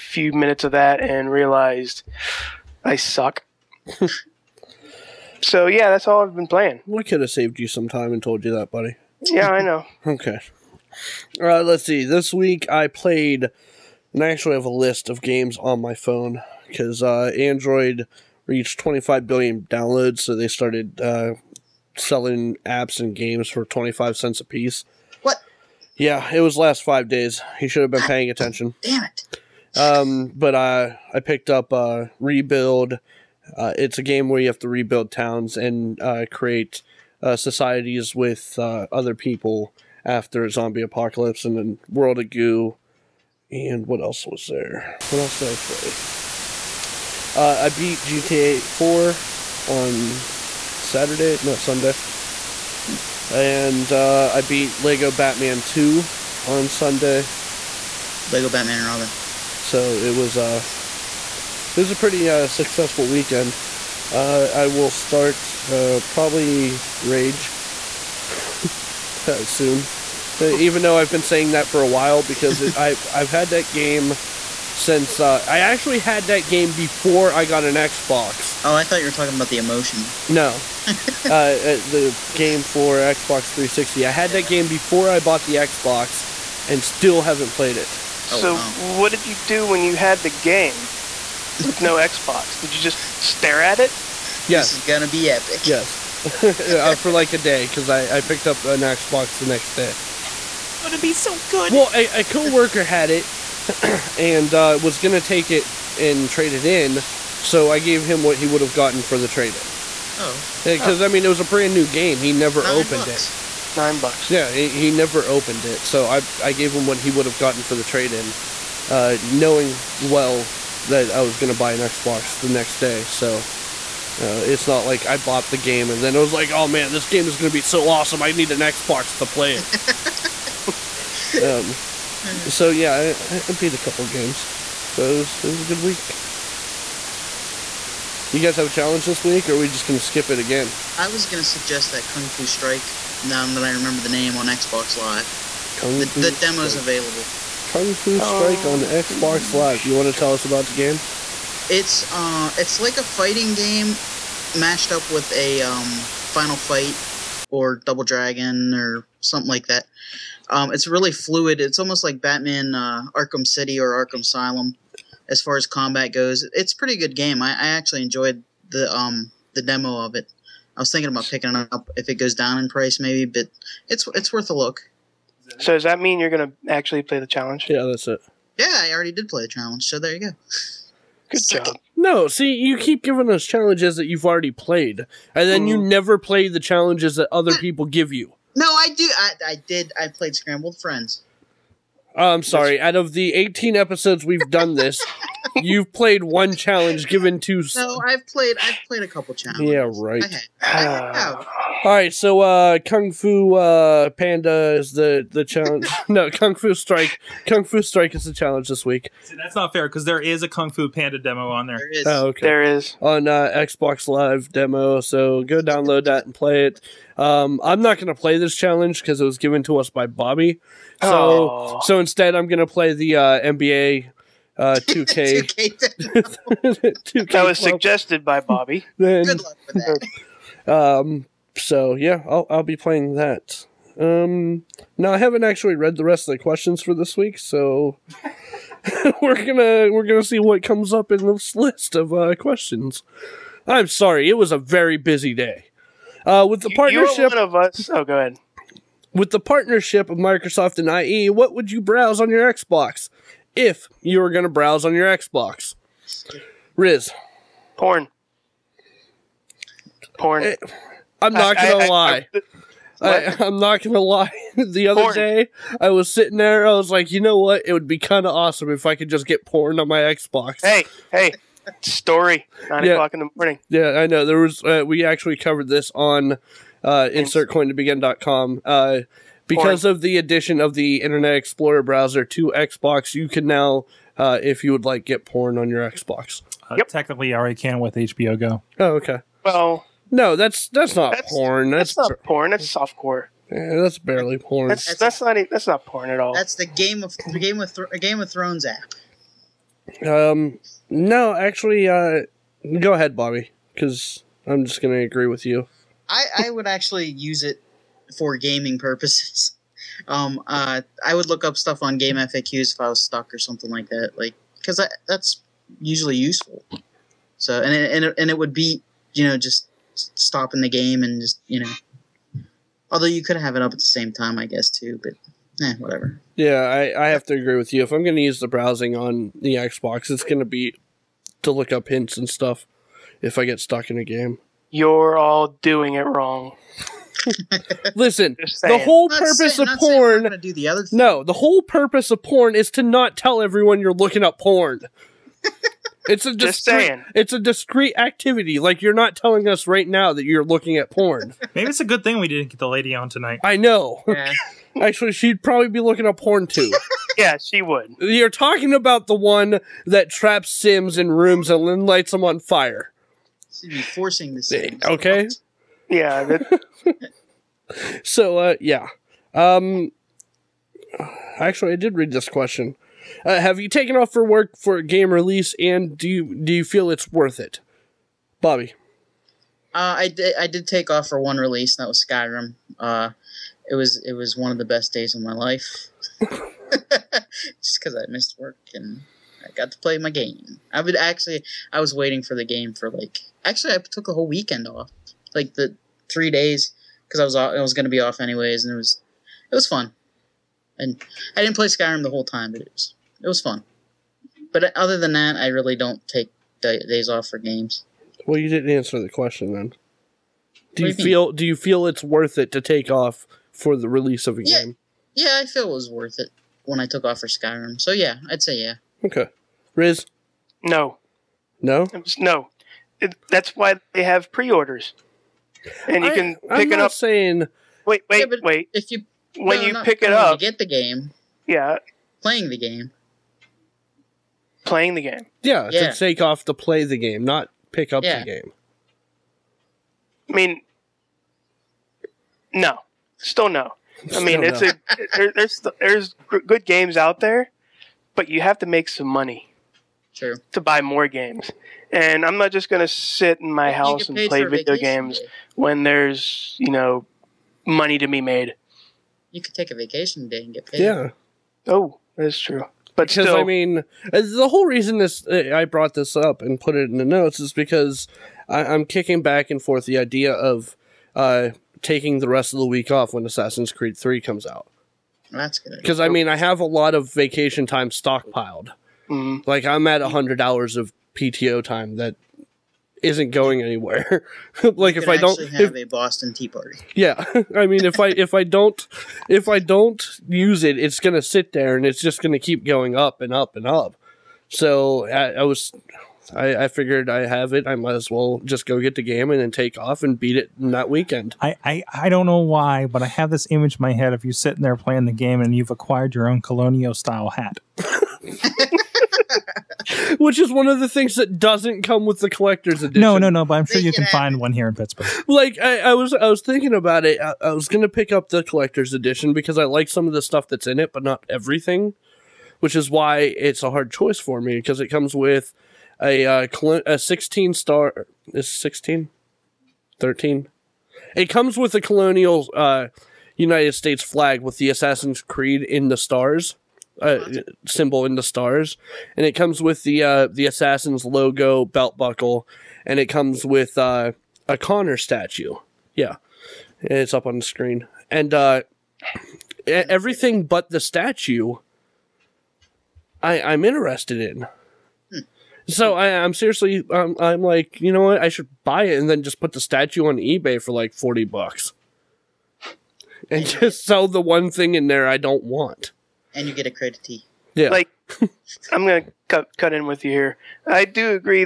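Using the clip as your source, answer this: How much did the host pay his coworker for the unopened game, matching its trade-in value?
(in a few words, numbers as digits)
Nine bucks.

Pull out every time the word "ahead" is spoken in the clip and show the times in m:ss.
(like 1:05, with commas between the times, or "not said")
4:08, 5:02.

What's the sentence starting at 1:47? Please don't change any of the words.
So I gave him what he would have gotten for the trade in.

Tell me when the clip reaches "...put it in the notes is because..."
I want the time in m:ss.
7:46.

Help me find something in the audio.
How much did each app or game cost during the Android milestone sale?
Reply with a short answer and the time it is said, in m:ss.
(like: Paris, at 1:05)
25 cents, at 0:23.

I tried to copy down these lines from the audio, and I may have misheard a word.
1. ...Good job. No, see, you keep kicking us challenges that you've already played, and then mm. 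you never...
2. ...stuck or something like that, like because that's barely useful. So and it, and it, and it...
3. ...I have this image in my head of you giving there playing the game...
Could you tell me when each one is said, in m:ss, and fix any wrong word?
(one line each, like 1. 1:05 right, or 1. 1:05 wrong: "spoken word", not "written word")
1. 3:01 wrong: "giving", not "kicking"
2. 5:13 wrong: "usually", not "barely"
3. 8:23 wrong: "sitting", not "giving".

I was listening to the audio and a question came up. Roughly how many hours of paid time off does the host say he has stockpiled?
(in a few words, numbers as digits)
100 hours.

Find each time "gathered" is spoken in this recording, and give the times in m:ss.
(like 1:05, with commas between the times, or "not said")
not said.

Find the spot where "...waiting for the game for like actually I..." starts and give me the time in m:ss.
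6:31.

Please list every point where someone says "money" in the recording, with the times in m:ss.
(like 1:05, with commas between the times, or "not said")
7:29, 7:37.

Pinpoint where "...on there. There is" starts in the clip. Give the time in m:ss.
3:31.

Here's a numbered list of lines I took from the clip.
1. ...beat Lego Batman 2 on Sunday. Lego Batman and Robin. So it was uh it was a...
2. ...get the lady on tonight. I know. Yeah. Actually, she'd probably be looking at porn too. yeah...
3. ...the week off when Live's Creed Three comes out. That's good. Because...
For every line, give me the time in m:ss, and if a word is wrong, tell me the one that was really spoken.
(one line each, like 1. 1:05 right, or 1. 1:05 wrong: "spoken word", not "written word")
1. 0:54 right
2. 5:52 right
3. 7:52 wrong: "Assassin", not "Live".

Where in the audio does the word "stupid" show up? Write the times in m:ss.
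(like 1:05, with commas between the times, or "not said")
not said.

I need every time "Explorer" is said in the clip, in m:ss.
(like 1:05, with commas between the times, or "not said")
4:41.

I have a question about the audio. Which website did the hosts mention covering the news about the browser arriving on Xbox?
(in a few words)
insertcointobegin.com.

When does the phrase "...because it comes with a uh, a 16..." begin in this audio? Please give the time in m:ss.
8:44.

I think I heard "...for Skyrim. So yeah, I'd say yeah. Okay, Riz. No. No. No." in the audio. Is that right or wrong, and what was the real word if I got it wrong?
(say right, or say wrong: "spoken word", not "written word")
right.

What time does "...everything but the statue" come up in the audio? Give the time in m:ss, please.
9:09.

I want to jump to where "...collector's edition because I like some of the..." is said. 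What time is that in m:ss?
8:38.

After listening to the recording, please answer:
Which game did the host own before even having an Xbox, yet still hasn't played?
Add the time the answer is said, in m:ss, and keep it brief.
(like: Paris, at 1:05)
Rage, at 1:07.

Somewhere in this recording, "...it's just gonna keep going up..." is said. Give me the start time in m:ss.
8:11.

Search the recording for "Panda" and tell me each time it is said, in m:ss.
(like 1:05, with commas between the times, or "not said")
3:24, 3:30.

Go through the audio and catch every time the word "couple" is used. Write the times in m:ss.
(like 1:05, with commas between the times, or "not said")
2:13, 3:19.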